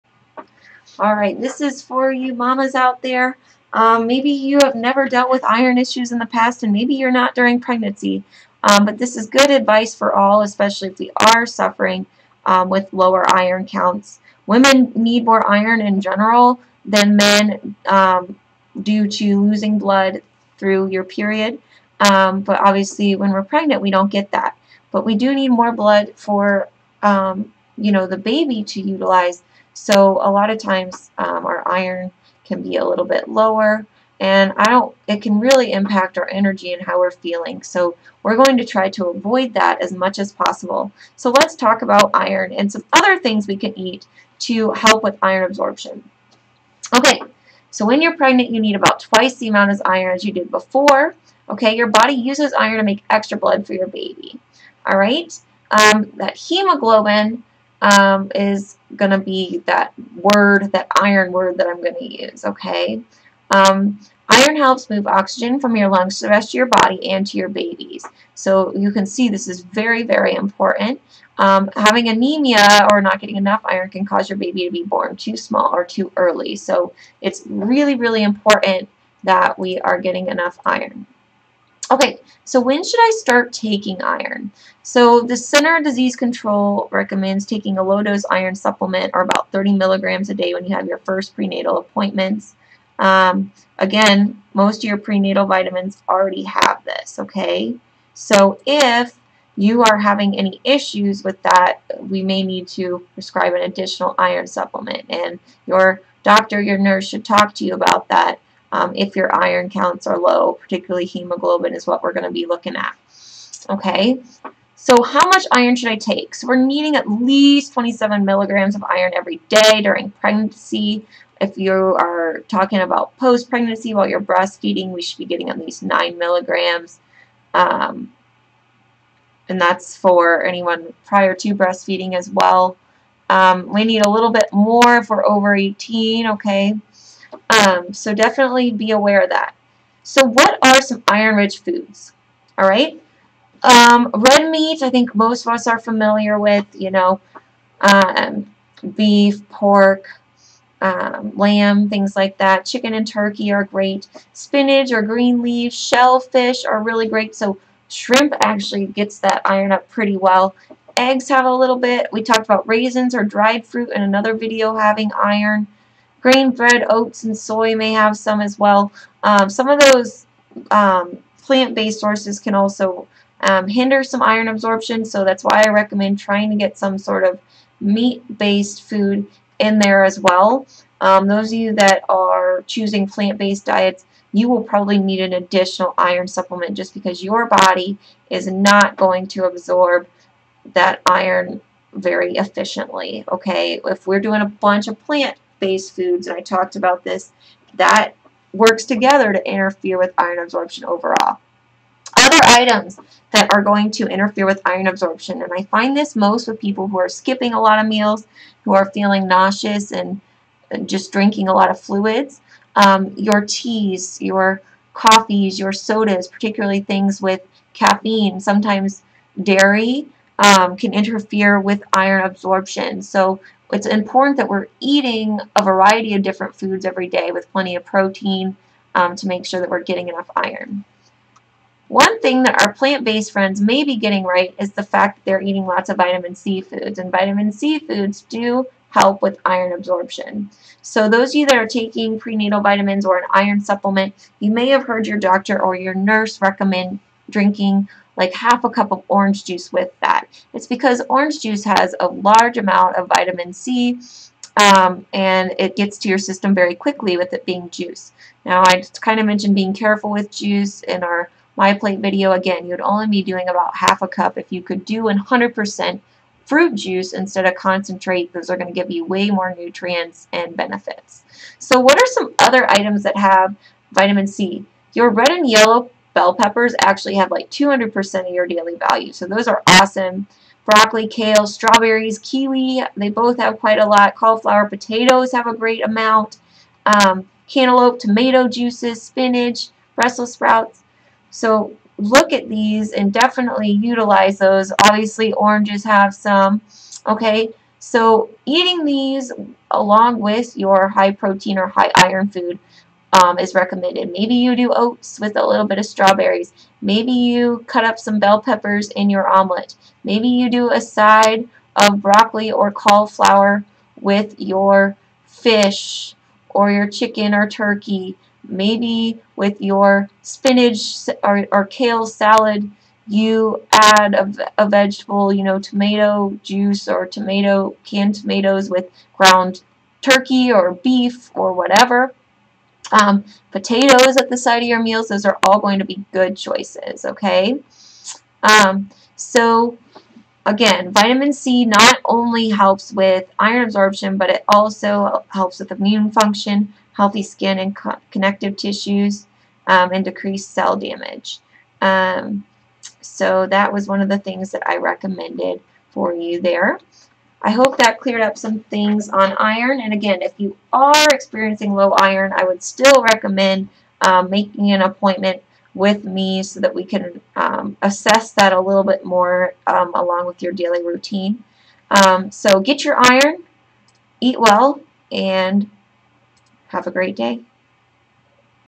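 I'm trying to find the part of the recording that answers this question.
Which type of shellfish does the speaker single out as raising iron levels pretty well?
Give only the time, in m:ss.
2:37.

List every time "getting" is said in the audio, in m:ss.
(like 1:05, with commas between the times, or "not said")
1:13, 1:19, 2:05, 3:49, 3:53.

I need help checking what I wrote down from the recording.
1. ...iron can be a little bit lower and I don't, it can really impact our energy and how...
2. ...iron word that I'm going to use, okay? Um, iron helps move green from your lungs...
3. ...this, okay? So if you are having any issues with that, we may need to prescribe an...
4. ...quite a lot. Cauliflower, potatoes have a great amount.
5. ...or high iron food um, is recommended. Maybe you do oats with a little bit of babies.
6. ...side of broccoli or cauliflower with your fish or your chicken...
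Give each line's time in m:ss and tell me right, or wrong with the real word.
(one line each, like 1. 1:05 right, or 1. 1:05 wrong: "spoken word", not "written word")
1. 0:31 right
2. 1:01 wrong: "oxygen", not "green"
3. 1:36 right
4. 4:43 right
5. 5:01 wrong: "strawberries", not "babies"
6. 5:10 right.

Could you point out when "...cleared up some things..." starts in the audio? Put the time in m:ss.
5:57.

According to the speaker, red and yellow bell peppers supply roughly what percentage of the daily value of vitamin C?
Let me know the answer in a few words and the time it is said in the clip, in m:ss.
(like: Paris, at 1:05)
200%, at 4:37.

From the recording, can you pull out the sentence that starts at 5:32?
Um, potatoes at the side of your meals, those are all going to be good choices, okay?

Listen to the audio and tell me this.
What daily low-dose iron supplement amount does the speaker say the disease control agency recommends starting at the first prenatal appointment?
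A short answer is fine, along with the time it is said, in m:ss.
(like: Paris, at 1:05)
30 milligrams, at 1:29.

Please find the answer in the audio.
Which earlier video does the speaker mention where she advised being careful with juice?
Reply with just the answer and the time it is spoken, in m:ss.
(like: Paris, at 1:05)
MyPlate video, at 4:21.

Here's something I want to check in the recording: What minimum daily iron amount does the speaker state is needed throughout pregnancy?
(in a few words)
27 milligrams.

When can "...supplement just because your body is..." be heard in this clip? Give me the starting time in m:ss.
3:06.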